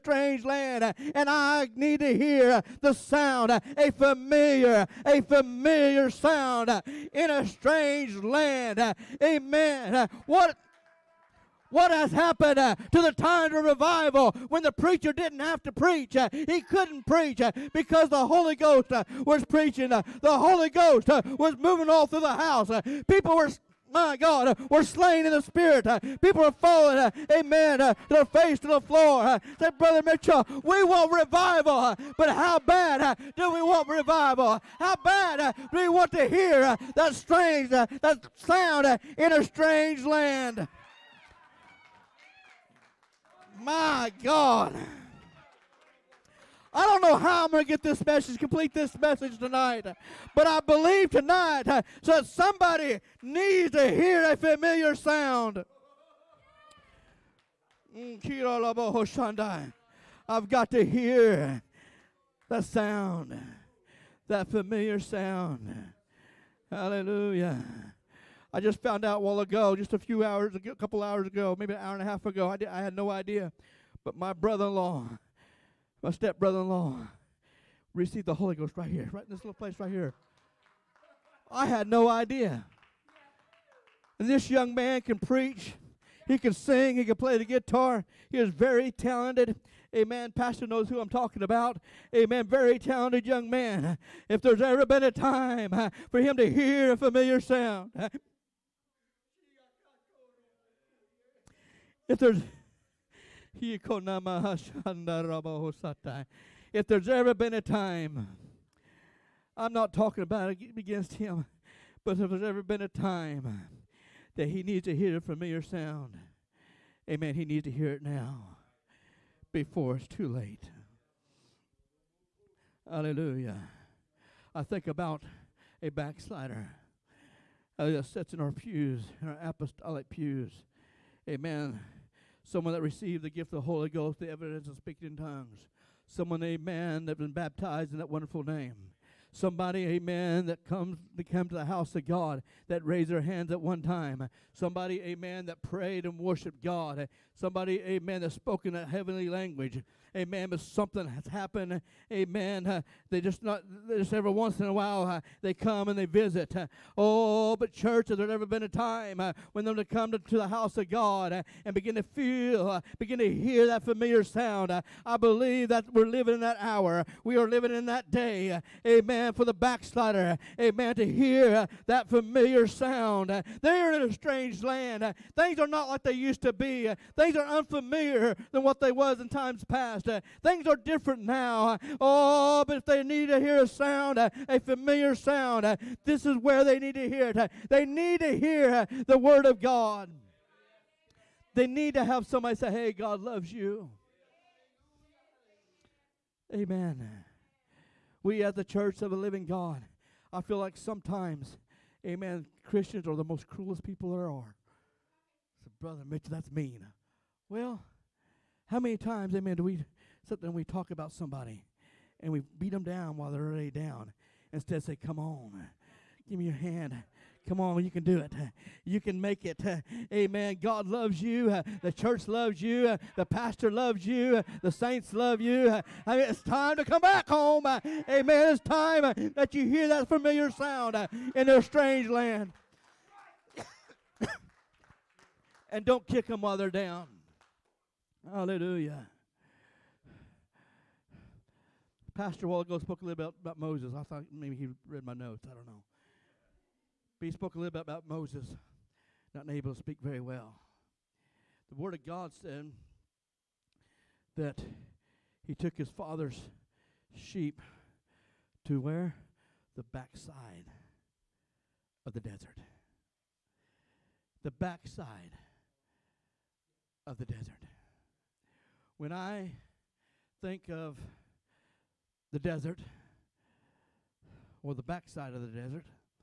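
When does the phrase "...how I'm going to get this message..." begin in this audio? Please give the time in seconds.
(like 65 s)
47 s.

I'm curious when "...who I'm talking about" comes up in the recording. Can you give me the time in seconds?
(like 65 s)
90 s.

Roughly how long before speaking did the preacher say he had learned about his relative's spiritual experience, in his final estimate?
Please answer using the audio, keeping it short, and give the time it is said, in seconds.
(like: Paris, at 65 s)
An hour and a half, at 71 s.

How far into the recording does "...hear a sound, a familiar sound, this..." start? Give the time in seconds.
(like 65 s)
183 s.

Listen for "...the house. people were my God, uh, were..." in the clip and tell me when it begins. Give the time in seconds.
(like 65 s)
22 s.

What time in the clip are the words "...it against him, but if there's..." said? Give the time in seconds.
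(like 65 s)
110 s.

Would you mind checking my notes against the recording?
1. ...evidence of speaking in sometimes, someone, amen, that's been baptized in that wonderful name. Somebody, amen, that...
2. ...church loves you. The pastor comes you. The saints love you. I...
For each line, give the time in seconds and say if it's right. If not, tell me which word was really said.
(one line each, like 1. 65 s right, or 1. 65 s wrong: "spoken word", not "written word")
1. 134 s wrong: "tongues", not "sometimes"
2. 221 s wrong: "loves", not "comes".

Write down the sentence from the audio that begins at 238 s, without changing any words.
Hallelujah pastor a while ago spoke a little bit about, about Moses.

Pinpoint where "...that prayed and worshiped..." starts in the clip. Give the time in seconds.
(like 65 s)
145 s.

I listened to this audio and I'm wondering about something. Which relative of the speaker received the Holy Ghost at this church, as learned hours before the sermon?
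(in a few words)
Step brother in law.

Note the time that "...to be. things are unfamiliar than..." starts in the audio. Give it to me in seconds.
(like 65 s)
176 s.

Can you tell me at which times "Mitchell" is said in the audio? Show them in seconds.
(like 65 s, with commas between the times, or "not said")
30 s, 206 s.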